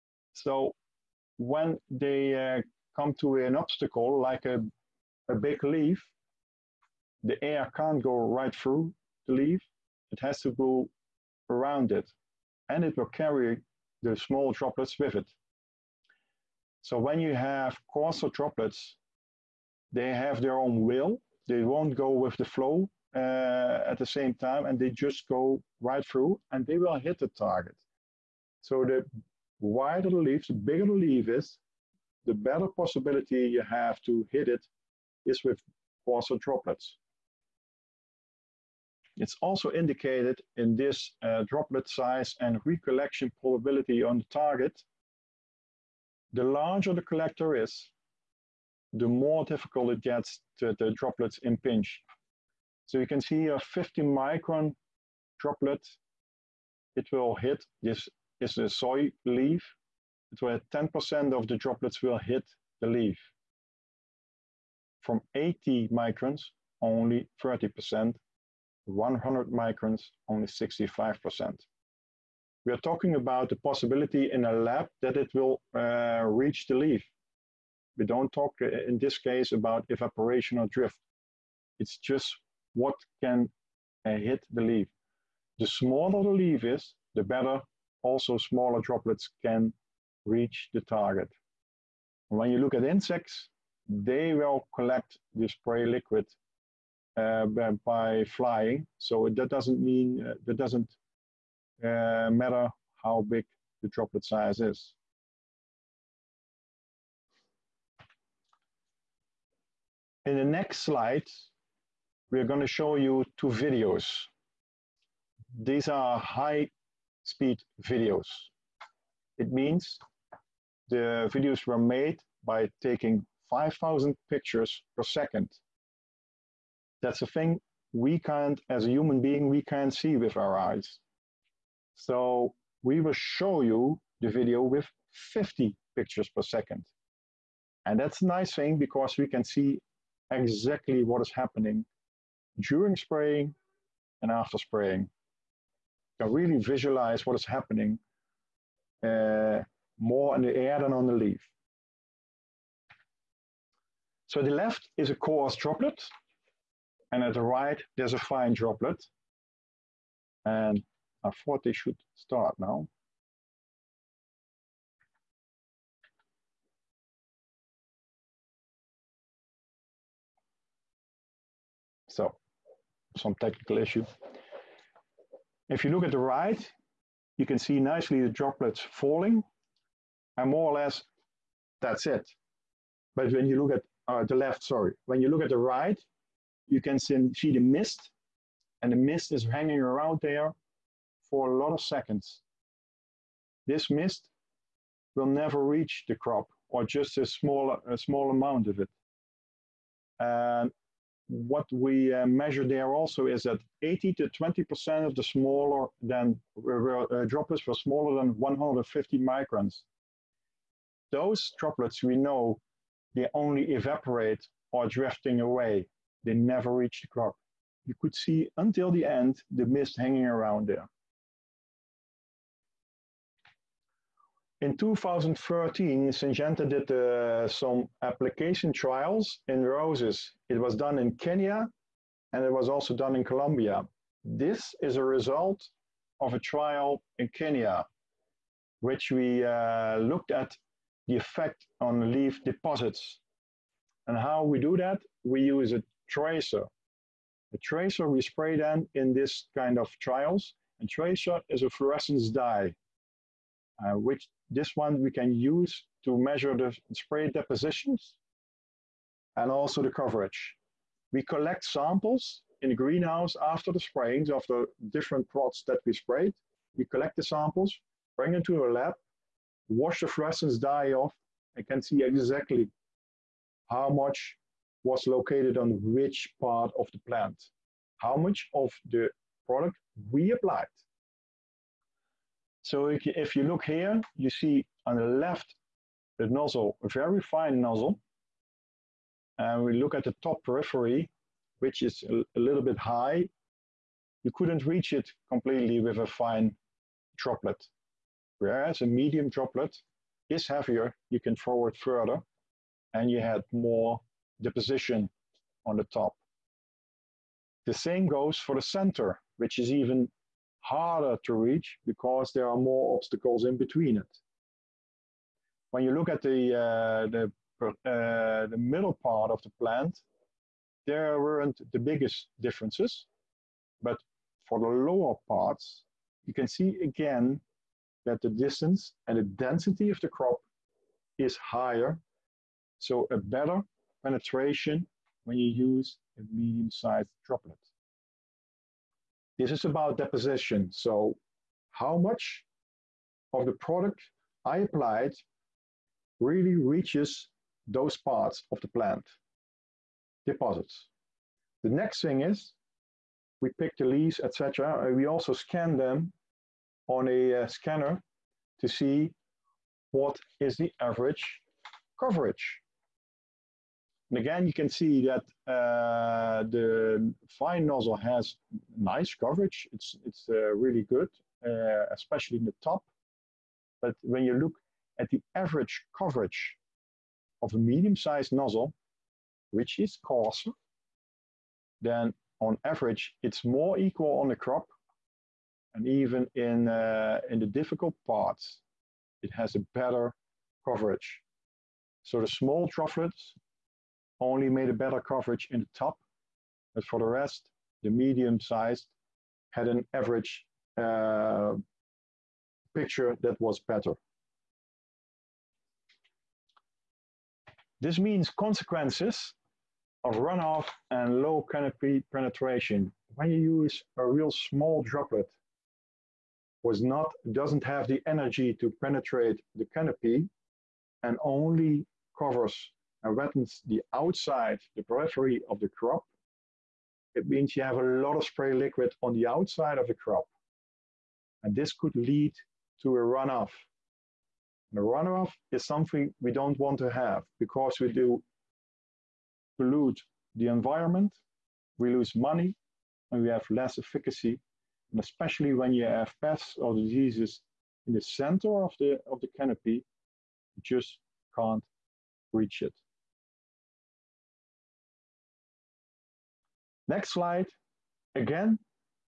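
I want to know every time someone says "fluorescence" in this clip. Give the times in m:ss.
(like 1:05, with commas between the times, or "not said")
4:11, 4:30.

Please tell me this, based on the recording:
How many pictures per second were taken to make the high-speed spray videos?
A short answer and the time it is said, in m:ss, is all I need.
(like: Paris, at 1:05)
5,000, at 2:03.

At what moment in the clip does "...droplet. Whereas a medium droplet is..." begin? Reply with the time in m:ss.
4:57.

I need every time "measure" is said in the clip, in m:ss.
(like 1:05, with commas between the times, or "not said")
3:22, 4:16.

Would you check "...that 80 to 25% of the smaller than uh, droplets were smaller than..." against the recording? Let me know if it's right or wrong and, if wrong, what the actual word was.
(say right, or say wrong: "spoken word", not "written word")
wrong: "20", not "25".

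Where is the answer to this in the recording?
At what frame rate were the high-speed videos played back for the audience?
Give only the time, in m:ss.
2:15.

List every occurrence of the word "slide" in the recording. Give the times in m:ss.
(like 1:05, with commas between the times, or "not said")
1:50, 7:37.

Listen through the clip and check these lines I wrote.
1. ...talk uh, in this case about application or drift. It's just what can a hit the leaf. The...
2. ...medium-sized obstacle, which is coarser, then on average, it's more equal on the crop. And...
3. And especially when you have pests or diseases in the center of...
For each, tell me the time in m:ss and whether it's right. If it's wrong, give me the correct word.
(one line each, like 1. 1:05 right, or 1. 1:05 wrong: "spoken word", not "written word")
1. 1:18 wrong: "evaporation", not "application"
2. 6:17 wrong: "nozzle", not "obstacle"
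3. 7:24 right.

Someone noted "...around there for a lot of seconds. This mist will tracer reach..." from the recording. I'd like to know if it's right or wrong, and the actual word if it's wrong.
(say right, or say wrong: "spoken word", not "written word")
wrong: "never", not "tracer".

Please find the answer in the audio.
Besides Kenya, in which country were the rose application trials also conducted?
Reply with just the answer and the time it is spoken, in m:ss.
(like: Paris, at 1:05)
Colombia, at 3:53.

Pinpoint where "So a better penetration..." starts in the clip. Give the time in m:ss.
5:32.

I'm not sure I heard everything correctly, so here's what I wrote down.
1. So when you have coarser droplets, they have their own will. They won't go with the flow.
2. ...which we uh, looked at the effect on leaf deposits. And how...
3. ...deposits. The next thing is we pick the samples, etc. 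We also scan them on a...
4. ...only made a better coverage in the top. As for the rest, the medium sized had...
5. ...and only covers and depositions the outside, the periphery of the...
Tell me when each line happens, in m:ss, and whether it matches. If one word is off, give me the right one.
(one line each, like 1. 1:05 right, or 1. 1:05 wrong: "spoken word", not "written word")
1. 0:16 right
2. 3:58 right
3. 5:50 wrong: "leaves", not "samples"
4. 6:34 right
5. 7:01 wrong: "wettens", not "depositions".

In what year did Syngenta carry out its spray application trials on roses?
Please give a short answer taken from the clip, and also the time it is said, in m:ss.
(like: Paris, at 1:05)
2013, at 3:44.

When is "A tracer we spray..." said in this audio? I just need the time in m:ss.
4:07.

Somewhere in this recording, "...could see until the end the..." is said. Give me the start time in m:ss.
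3:38.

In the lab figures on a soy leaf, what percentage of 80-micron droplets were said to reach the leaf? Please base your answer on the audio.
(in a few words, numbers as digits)
30%.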